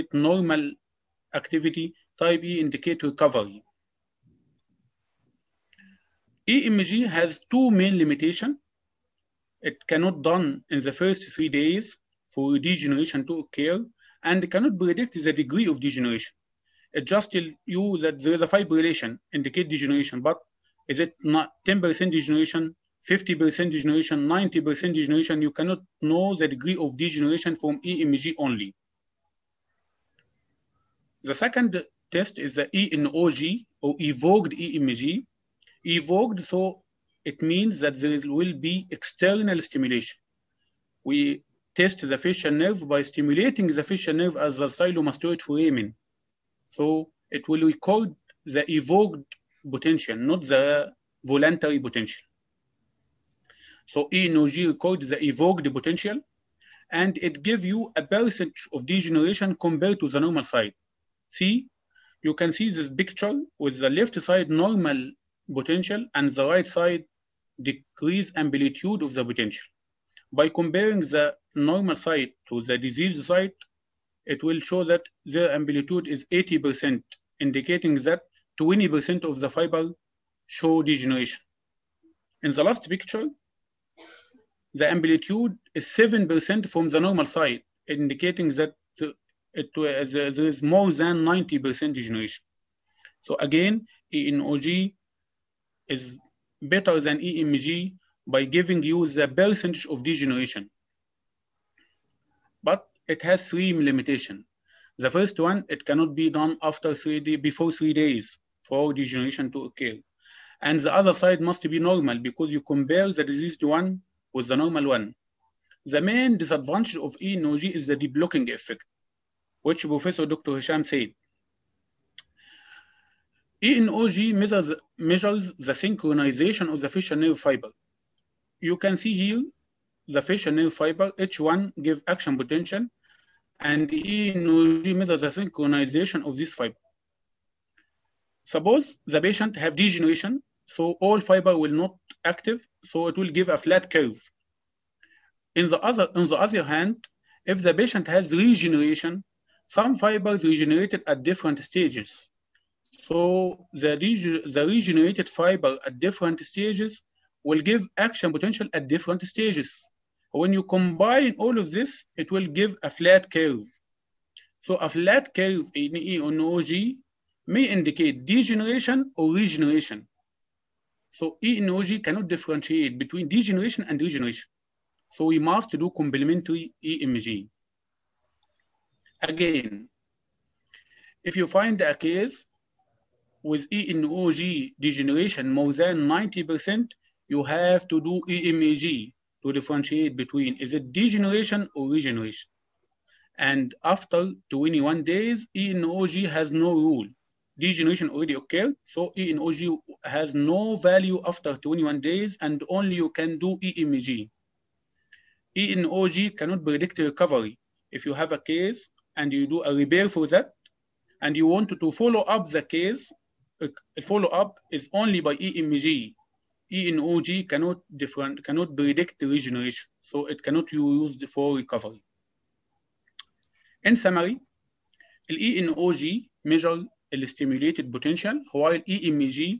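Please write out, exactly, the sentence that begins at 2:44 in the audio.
So a flat curve in E on OG may indicate degeneration or regeneration.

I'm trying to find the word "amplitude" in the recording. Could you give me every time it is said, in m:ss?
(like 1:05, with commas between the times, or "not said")
1:08, 1:15, 1:24.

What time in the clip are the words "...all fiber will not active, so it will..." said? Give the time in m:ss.
2:21.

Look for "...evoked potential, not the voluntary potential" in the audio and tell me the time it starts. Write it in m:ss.
0:48.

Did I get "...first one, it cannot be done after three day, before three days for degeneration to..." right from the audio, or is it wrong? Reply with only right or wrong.
right.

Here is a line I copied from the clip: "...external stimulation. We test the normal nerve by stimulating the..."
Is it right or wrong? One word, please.
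wrong.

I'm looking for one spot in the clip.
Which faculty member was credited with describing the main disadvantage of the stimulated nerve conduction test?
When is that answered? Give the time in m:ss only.
1:59.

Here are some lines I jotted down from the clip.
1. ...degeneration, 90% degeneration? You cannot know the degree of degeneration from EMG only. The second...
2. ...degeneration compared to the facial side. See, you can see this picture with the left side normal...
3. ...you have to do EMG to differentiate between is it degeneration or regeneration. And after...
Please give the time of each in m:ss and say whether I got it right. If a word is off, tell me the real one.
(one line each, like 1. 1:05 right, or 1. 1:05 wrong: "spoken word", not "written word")
1. 0:23 right
2. 0:58 wrong: "normal", not "facial"
3. 3:07 right.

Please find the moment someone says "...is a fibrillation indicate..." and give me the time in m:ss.
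0:18.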